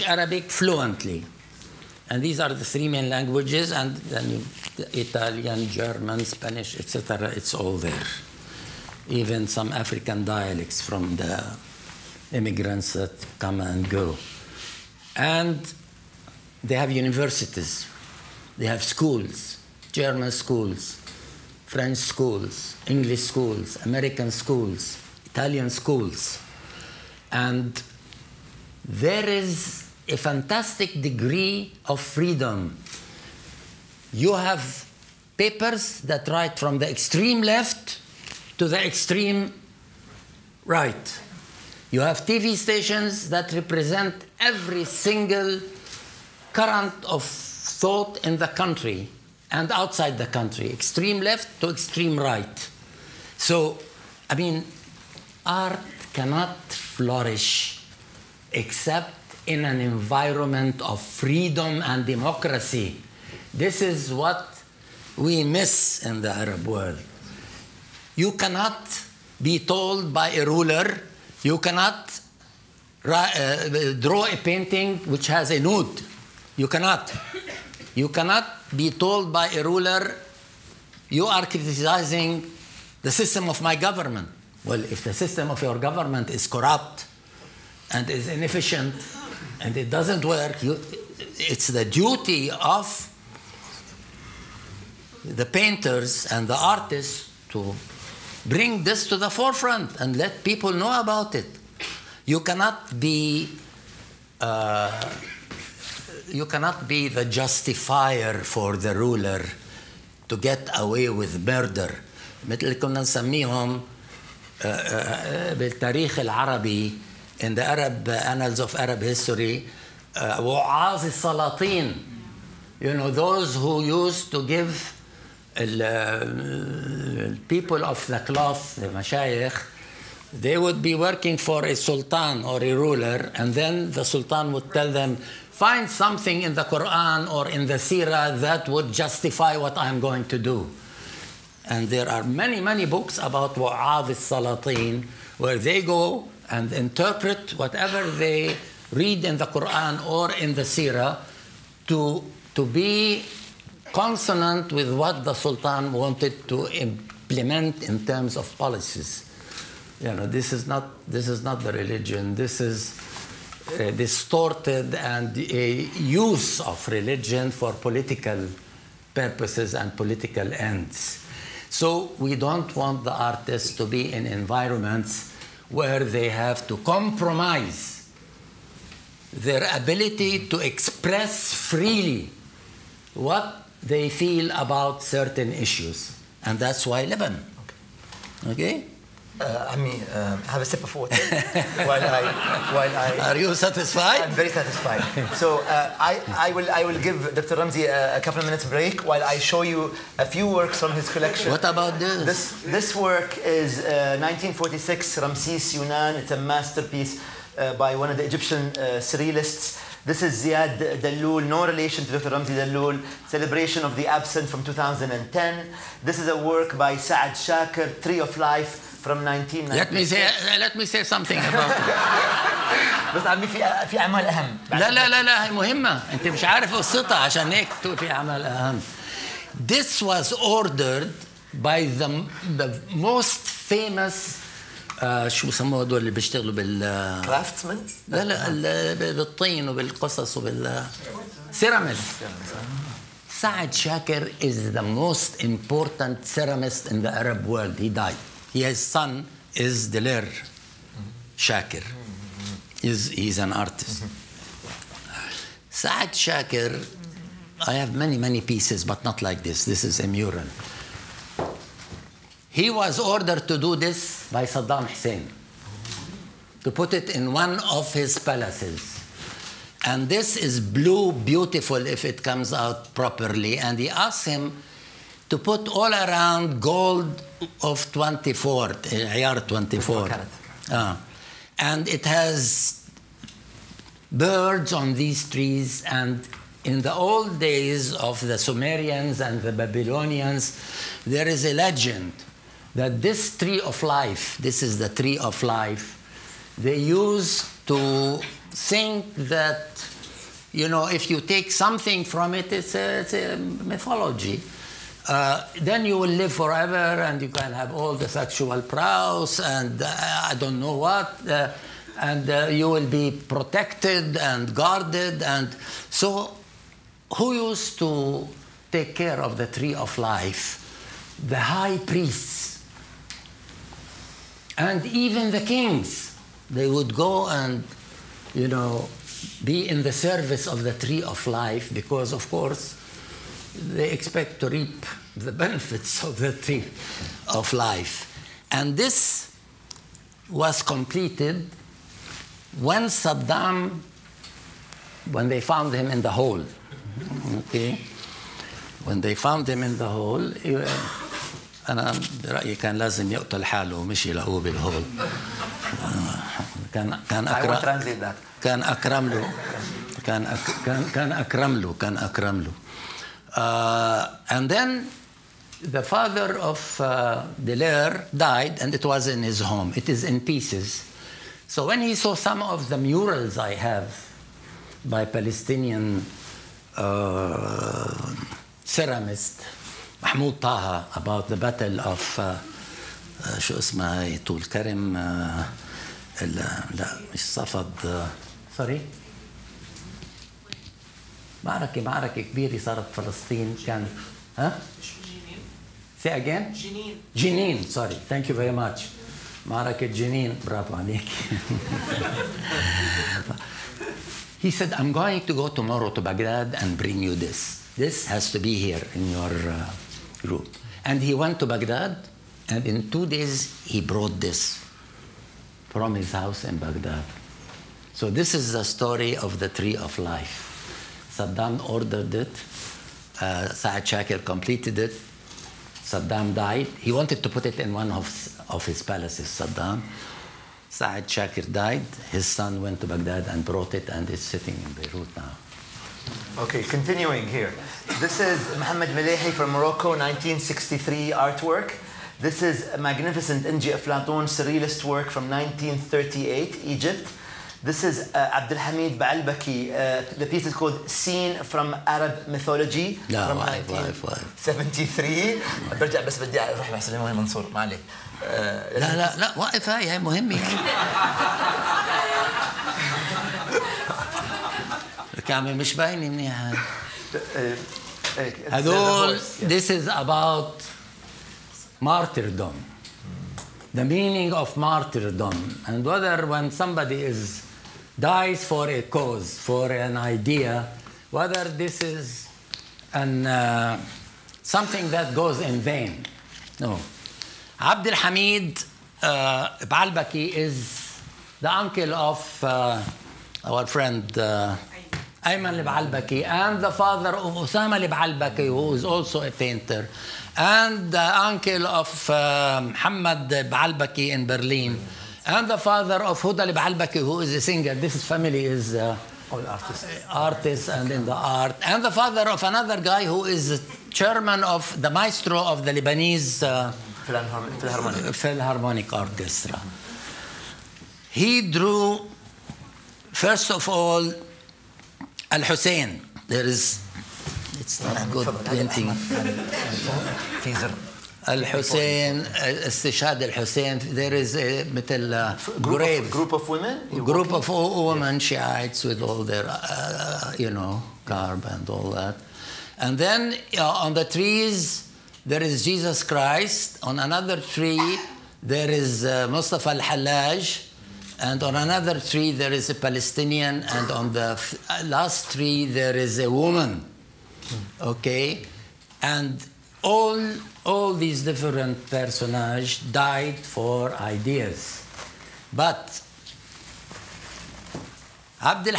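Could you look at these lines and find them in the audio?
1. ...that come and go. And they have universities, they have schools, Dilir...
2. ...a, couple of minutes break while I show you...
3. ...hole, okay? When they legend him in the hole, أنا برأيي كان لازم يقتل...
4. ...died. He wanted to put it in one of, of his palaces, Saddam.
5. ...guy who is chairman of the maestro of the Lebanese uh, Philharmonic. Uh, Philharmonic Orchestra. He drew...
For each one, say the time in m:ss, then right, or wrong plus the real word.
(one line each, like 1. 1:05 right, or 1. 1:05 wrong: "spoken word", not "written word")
1. 0:12 wrong: "German", not "Dilir"
2. 3:18 right
3. 5:46 wrong: "found", not "legend"
4. 7:06 right
5. 8:32 right.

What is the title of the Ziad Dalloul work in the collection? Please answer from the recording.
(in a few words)
Celebration of the absent.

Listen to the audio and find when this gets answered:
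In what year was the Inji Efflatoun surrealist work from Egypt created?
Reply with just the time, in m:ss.
7:25.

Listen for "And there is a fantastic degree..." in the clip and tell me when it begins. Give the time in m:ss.
0:27.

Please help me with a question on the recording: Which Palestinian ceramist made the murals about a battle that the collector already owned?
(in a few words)
Mahmoud Taha.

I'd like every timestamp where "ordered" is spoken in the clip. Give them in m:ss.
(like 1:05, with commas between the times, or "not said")
3:50, 4:22, 7:01.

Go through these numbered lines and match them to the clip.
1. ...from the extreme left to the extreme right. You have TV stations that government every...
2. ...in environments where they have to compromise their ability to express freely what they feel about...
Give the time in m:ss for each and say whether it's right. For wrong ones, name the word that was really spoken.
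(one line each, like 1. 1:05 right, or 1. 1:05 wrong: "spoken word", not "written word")
1. 0:36 wrong: "represent", not "government"
2. 2:54 right.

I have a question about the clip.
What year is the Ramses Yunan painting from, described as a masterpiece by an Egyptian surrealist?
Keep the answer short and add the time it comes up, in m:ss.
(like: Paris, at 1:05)
1946, at 3:23.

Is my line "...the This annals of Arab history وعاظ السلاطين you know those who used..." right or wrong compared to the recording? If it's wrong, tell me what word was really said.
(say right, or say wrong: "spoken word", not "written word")
wrong: "Arab", not "This".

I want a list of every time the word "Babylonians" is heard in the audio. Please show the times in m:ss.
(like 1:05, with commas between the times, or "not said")
4:49.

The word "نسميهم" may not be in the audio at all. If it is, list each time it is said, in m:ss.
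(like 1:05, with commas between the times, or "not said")
1:53.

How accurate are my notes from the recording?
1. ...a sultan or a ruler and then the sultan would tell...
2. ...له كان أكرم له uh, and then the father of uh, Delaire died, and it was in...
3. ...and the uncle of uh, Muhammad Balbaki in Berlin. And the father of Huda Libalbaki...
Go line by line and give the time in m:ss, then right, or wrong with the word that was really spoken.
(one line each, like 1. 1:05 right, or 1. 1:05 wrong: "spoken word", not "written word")
1. 2:11 right
2. 6:01 right
3. 8:20 right.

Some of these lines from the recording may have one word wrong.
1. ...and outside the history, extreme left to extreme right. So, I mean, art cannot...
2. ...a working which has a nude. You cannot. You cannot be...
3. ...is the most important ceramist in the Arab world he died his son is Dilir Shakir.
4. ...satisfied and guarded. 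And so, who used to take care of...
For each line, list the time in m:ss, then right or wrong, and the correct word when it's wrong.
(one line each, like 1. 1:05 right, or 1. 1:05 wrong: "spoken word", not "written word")
1. 0:49 wrong: "country", not "history"
2. 1:14 wrong: "painting", not "working"
3. 4:04 right
4. 5:13 wrong: "protected", not "satisfied".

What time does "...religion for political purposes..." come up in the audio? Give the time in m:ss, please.
2:46.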